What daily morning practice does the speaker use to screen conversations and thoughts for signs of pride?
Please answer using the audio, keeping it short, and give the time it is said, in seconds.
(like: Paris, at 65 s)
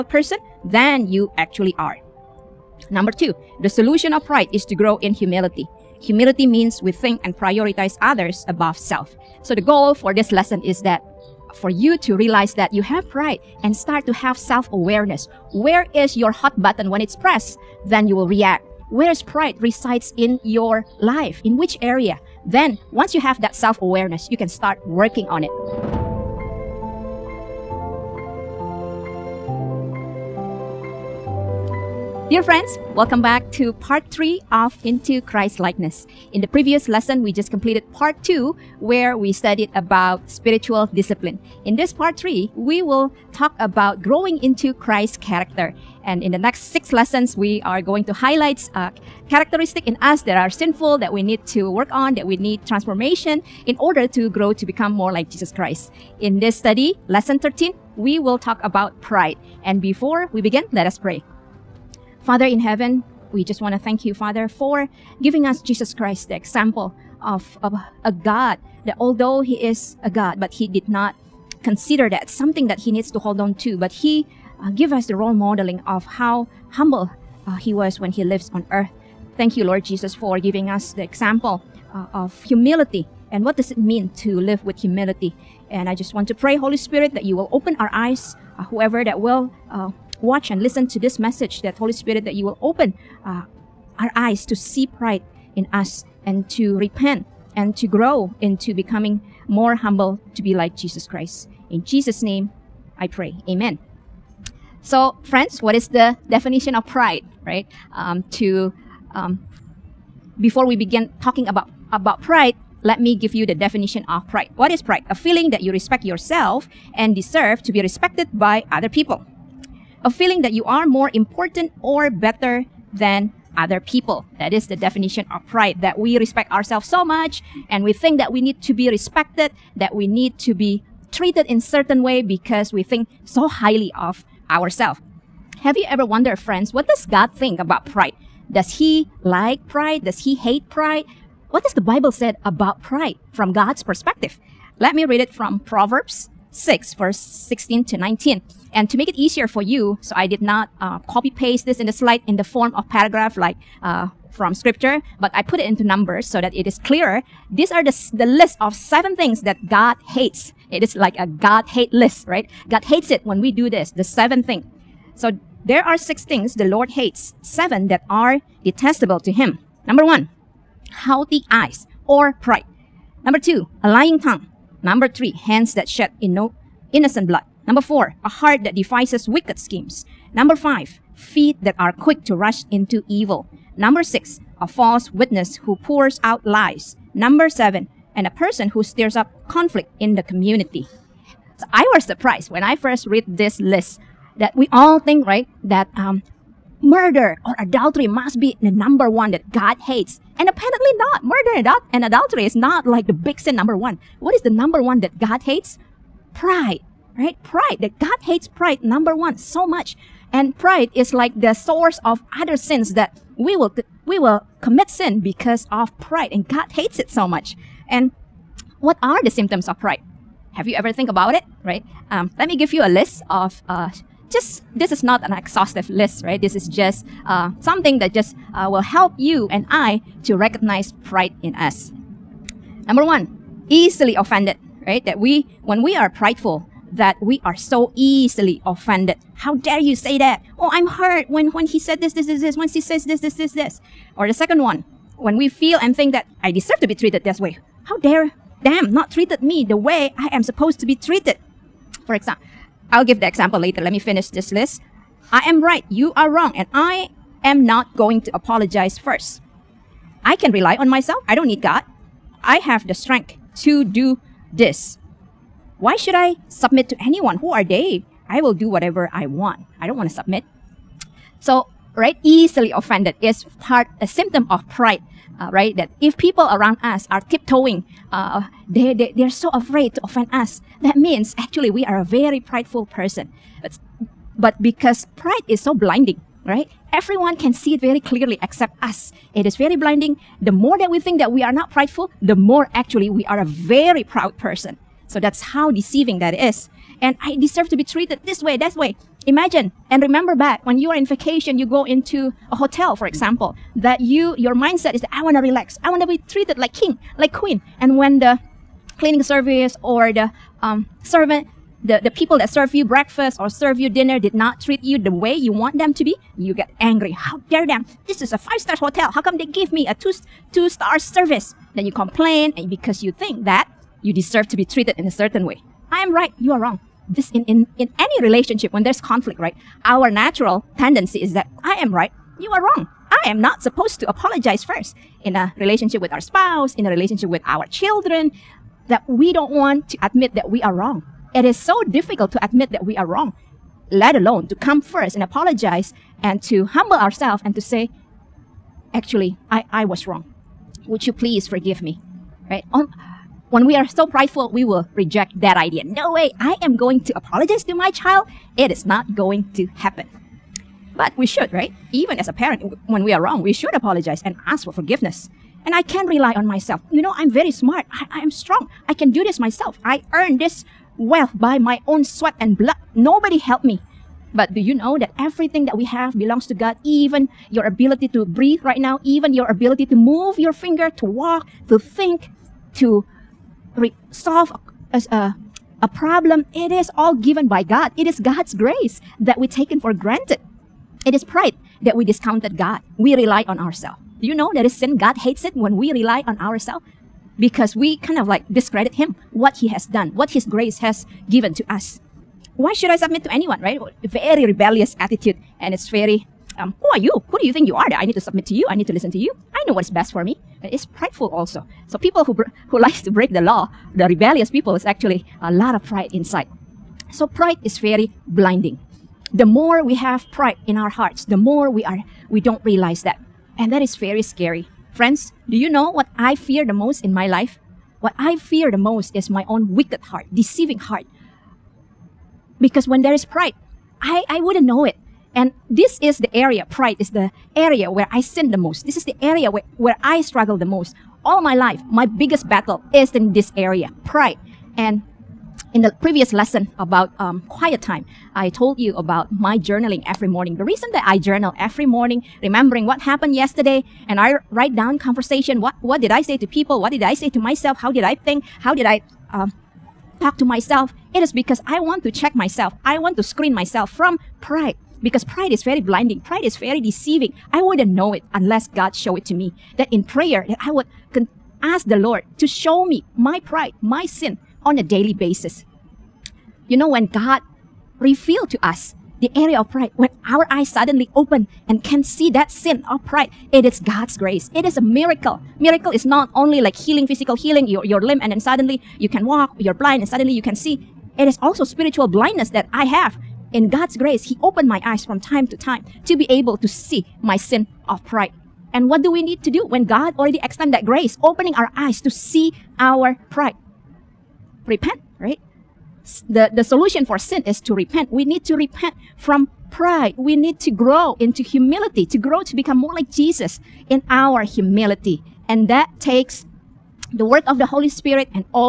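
Journaling, at 449 s.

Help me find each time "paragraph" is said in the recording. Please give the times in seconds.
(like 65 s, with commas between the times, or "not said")
152 s.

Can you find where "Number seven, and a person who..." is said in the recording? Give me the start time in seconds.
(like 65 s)
187 s.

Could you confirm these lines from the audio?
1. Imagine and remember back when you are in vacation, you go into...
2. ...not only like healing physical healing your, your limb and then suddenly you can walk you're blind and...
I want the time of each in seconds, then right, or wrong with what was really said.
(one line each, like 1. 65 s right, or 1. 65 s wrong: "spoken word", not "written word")
1. 299 s right
2. 486 s right.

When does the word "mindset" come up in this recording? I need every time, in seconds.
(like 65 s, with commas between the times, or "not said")
304 s.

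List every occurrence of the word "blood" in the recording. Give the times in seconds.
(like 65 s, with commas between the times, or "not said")
177 s, 372 s.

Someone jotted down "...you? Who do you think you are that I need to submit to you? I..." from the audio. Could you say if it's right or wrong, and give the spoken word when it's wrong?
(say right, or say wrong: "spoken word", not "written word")
right.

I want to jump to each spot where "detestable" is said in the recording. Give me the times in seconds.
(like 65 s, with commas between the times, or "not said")
168 s.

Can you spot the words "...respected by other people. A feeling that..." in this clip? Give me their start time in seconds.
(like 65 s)
117 s.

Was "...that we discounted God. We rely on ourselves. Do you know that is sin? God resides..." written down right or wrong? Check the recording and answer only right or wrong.
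wrong.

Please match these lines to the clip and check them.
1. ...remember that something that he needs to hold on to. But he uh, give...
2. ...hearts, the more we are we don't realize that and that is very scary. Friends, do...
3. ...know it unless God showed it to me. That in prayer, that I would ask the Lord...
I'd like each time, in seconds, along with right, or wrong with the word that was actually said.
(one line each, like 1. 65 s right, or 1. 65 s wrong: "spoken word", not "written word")
1. 71 s wrong: "consider", not "remember"
2. 420 s right
3. 467 s right.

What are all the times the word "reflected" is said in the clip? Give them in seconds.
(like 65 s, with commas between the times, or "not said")
not said.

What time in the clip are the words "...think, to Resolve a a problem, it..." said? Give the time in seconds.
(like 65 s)
381 s.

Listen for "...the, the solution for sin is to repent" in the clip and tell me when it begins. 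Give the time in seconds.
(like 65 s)
506 s.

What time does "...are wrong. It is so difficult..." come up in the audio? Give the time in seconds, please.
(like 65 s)
340 s.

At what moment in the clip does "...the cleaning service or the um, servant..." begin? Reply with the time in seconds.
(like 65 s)
308 s.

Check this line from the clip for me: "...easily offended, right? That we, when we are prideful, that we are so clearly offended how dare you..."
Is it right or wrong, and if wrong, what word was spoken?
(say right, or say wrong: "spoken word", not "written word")
wrong: "easily", not "clearly".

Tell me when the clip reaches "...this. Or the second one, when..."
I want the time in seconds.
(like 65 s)
243 s.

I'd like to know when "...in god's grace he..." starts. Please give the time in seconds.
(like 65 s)
493 s.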